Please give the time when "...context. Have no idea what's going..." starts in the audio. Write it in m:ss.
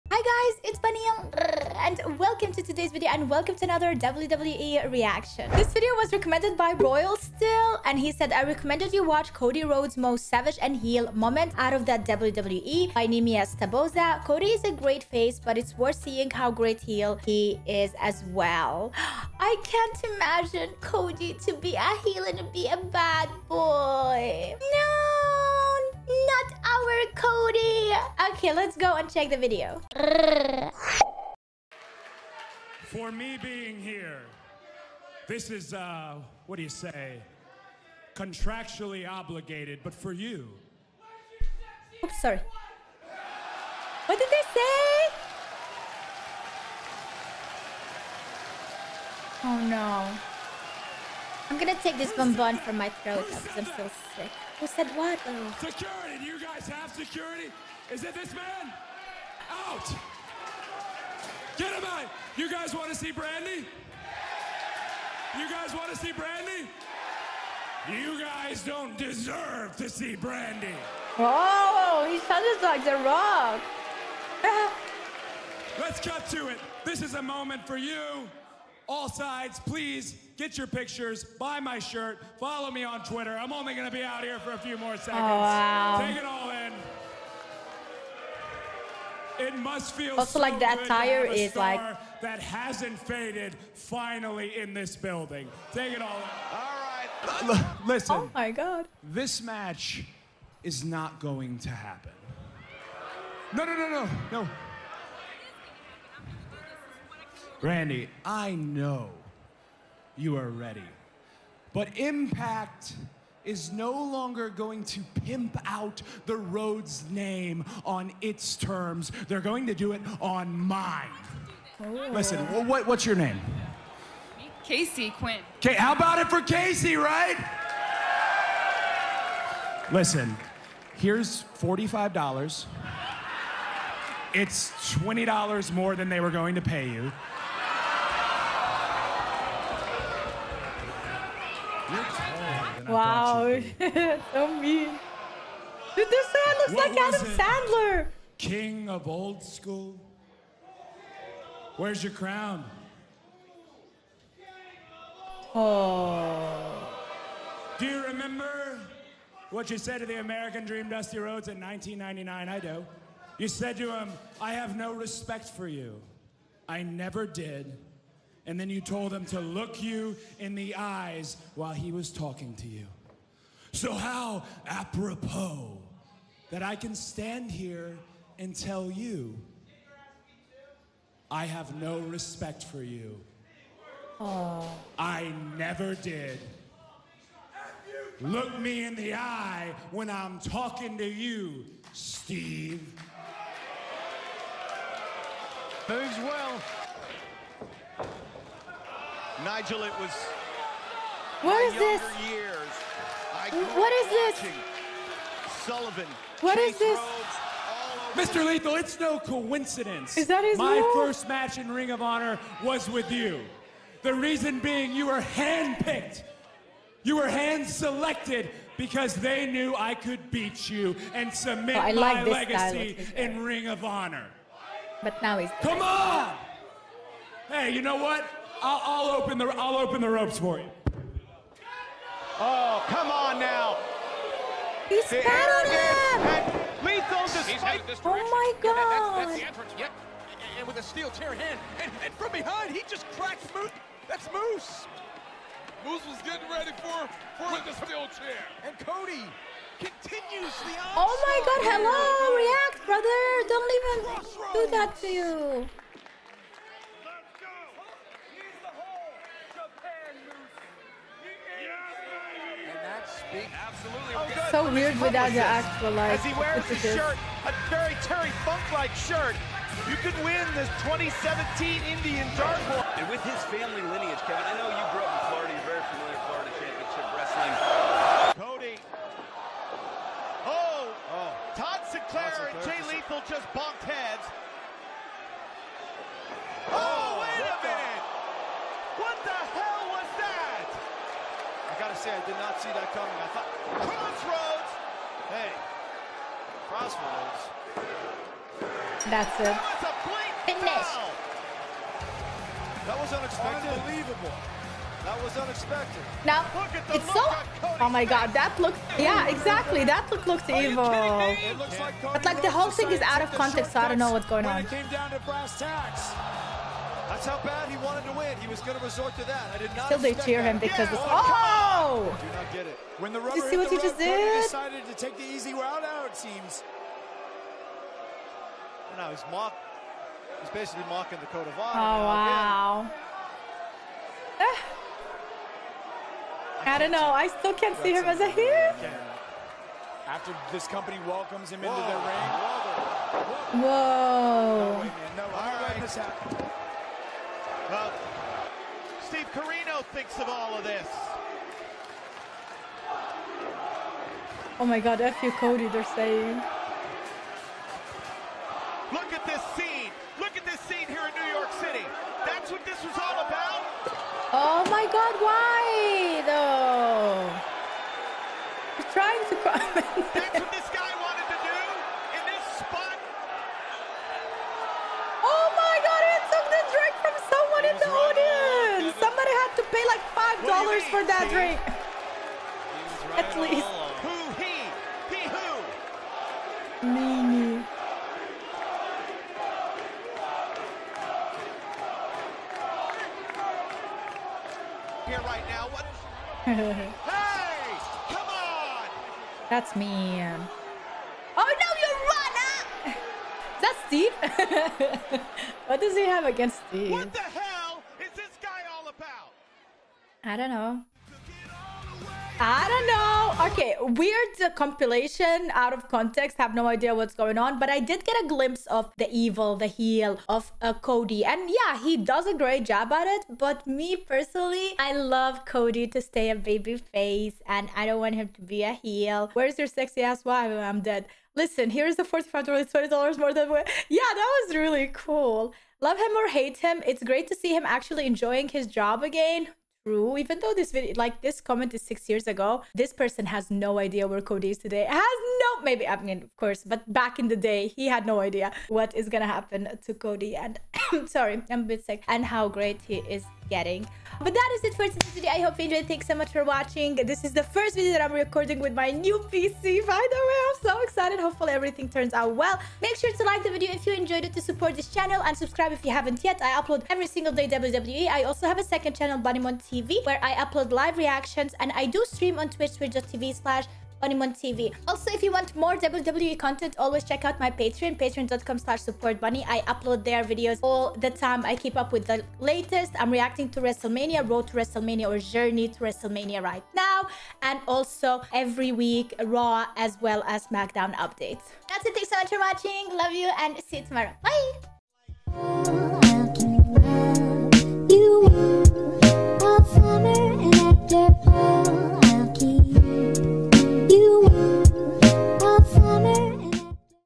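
6:55.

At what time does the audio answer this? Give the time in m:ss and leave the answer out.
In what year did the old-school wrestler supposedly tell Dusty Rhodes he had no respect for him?
2:41.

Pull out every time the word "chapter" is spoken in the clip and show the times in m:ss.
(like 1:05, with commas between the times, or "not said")
not said.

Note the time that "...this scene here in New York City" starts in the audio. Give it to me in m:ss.
6:00.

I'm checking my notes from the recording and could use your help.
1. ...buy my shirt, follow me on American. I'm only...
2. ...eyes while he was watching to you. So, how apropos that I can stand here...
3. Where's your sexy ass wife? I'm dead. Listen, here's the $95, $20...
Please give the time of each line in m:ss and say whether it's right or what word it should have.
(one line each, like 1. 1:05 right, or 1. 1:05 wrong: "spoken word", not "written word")
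1. 1:21 wrong: "Twitter", not "American"
2. 2:50 wrong: "talking", not "watching"
3. 7:09 wrong: "45", not "95".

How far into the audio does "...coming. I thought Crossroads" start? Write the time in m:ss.
4:52.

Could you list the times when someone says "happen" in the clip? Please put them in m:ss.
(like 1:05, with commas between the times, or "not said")
1:41, 7:29.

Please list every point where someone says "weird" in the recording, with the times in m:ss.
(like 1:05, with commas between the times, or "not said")
4:24, 6:53.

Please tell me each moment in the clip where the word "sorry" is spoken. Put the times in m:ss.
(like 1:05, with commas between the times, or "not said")
0:42, 7:31.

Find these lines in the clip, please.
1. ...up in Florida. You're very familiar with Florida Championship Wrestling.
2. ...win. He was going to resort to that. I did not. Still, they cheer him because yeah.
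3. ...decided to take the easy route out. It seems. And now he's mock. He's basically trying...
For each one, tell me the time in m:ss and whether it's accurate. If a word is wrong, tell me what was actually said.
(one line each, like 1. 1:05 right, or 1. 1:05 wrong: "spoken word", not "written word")
1. 4:35 right
2. 5:18 right
3. 5:24 wrong: "mocking", not "trying".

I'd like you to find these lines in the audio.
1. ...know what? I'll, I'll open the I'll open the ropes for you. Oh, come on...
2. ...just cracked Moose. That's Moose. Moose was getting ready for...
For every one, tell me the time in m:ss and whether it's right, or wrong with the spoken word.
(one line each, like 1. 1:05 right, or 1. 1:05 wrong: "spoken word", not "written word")
1. 3:47 right
2. 4:02 right.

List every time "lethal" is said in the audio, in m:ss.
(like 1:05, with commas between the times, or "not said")
3:28, 3:56, 4:42.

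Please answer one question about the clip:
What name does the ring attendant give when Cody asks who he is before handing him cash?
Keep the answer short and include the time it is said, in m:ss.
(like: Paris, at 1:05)
Casey Quinn, at 2:04.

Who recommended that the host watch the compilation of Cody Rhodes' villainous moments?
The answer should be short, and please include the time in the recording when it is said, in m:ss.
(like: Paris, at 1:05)
Royal Still, at 0:06.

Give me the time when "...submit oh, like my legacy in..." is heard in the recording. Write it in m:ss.
3:41.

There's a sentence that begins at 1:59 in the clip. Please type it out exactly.
They're going to do it on mine.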